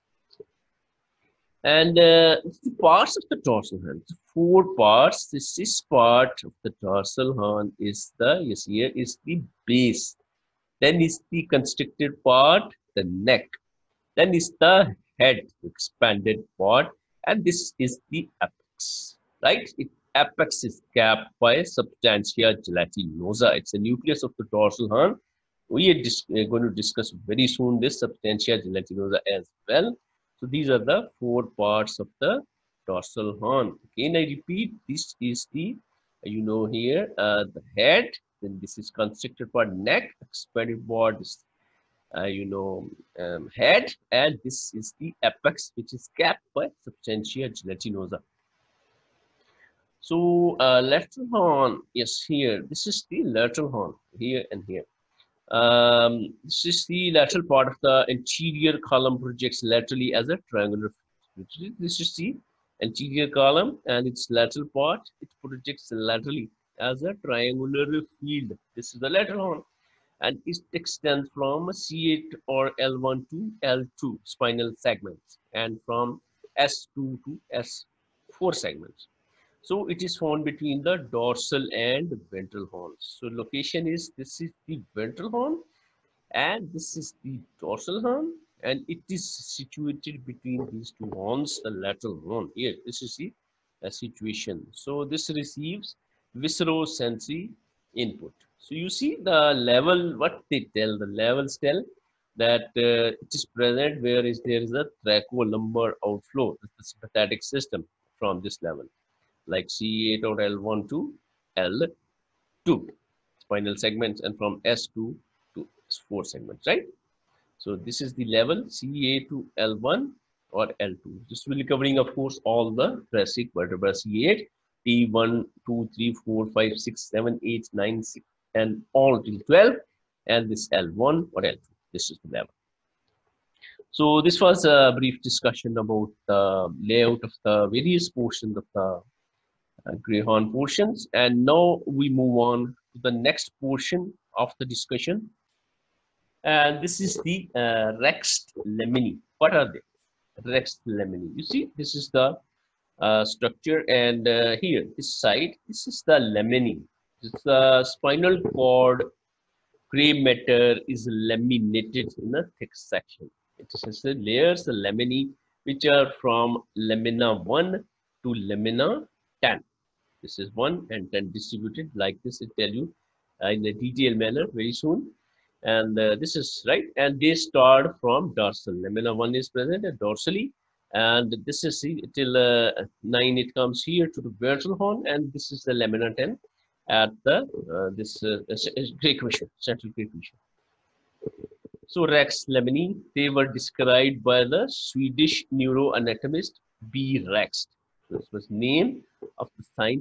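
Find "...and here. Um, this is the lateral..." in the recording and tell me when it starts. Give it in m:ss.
0:54.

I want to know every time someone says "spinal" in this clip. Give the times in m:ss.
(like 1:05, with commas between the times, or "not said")
1:14, 1:53, 2:37.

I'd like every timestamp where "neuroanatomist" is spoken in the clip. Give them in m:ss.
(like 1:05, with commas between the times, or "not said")
3:15.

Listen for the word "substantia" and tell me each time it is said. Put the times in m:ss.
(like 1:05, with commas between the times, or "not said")
0:21, 0:28, 0:46.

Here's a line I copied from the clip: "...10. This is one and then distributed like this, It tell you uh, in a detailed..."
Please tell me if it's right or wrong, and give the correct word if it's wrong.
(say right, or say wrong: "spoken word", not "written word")
right.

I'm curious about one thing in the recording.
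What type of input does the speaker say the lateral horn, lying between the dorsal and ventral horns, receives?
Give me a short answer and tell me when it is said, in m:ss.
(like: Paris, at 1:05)
Viscerosensory input, at 1:36.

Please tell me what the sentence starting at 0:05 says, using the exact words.
The sixth part of the dorsal horn is the see here is the base.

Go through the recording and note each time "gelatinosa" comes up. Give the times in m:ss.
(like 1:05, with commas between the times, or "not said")
0:22, 0:28, 0:47.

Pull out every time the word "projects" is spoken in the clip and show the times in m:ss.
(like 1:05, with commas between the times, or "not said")
0:59, 1:05.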